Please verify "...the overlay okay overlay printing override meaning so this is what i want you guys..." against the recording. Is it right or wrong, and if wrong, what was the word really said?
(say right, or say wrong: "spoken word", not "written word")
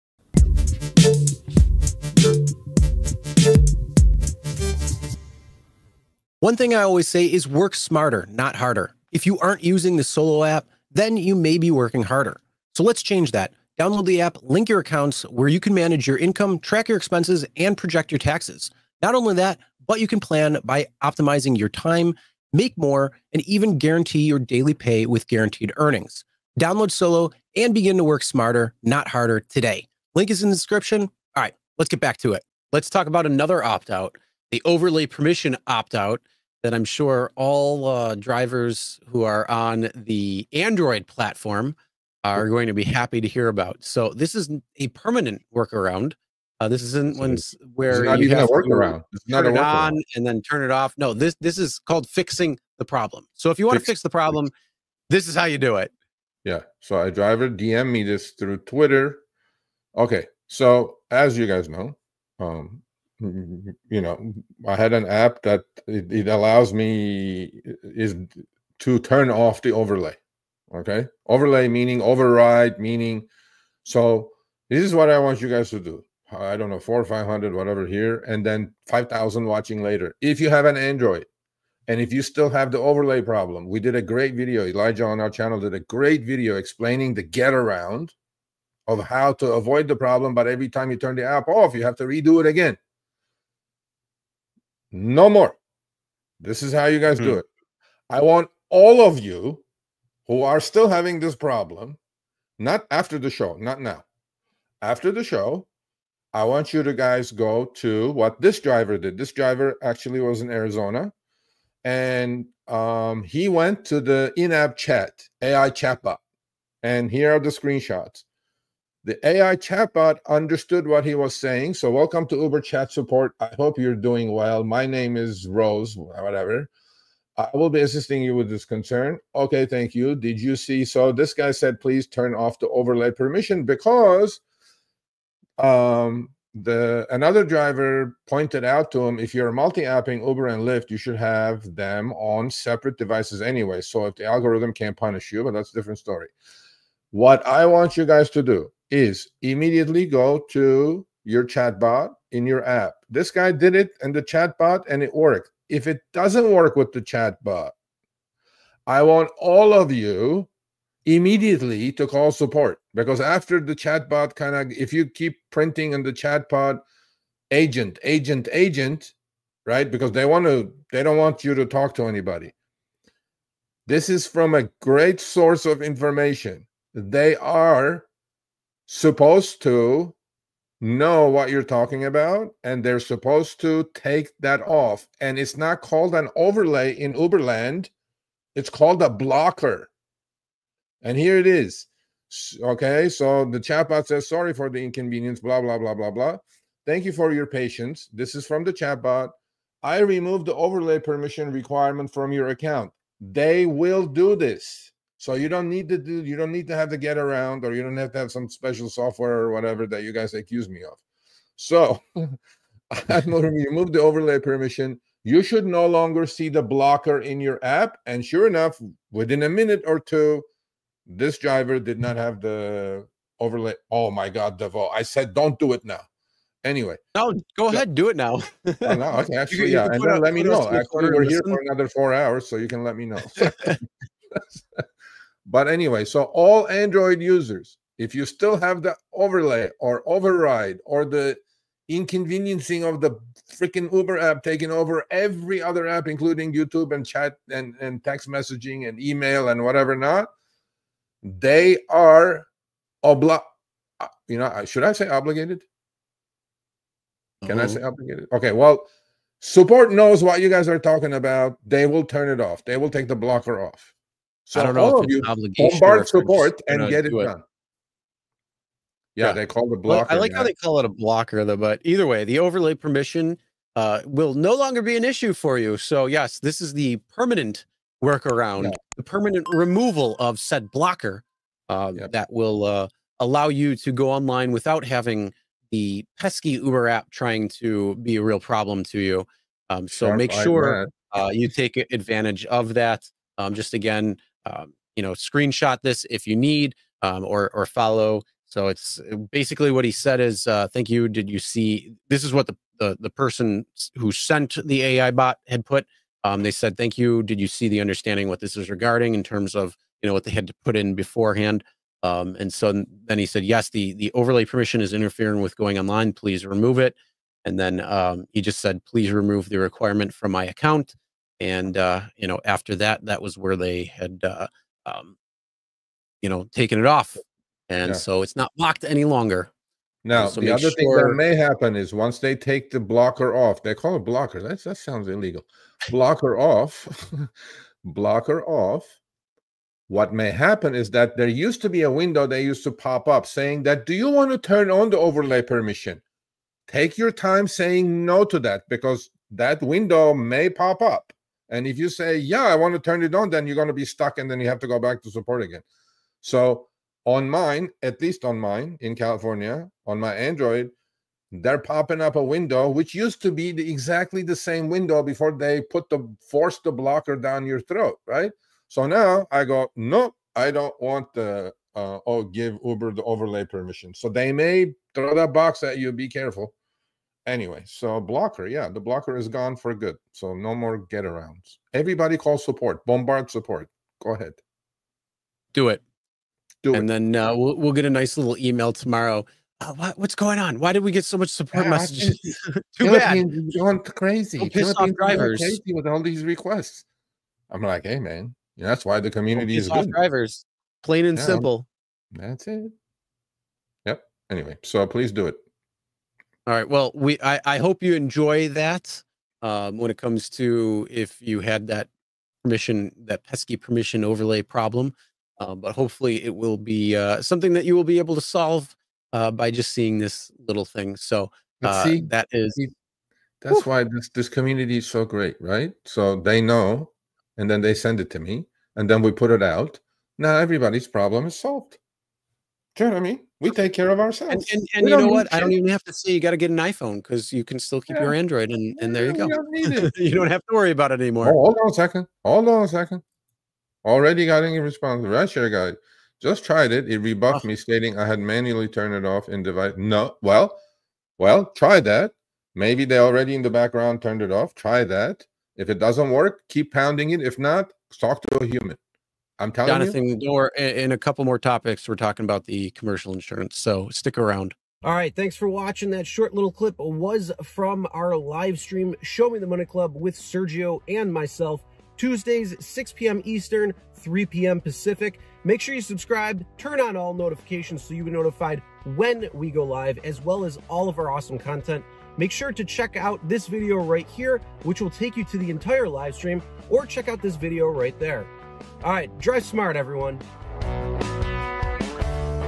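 wrong: "meaning", not "printing".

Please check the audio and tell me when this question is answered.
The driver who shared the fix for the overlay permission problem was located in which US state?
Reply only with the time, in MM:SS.
01:50.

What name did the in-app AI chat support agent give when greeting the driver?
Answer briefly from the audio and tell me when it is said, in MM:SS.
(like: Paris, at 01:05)
Rose, at 02:05.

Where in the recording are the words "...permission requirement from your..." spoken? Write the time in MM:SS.
03:20.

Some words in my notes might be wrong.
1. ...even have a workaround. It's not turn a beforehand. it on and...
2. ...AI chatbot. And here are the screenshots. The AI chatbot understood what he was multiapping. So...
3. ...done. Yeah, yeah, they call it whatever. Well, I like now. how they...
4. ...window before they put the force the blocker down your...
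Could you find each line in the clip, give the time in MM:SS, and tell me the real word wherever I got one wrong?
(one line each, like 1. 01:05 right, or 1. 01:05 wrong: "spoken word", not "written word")
1. 00:48 wrong: "workaround", not "beforehand"
2. 01:55 wrong: "saying", not "multiapping"
3. 04:27 wrong: "blocker", not "whatever"
4. 06:04 right.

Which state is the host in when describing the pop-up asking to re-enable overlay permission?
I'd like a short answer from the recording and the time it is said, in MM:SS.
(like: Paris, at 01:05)
California, at 05:58.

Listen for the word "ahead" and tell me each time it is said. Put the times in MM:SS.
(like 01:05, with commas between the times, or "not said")
03:47, 06:24.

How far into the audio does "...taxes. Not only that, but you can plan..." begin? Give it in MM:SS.
00:18.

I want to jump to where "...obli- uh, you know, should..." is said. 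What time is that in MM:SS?
04:13.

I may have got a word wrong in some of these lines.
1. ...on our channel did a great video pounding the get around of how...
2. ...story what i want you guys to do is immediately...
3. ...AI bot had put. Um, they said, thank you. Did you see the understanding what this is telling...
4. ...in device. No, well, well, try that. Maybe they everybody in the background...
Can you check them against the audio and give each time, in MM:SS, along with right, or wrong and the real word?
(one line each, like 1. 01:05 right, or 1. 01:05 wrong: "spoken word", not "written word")
1. 01:25 wrong: "explaining", not "pounding"
2. 02:25 right
3. 05:04 wrong: "regarding", not "telling"
4. 07:29 wrong: "already", not "everybody".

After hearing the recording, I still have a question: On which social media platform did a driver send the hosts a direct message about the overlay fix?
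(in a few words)
Twitter.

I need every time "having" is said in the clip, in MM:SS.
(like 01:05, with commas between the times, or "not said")
01:40, 04:44.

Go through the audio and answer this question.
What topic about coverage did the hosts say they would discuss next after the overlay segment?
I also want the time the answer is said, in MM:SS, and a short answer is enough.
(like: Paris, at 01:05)
commercial insurance, at 07:42.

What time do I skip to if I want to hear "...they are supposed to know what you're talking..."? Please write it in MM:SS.
02:56.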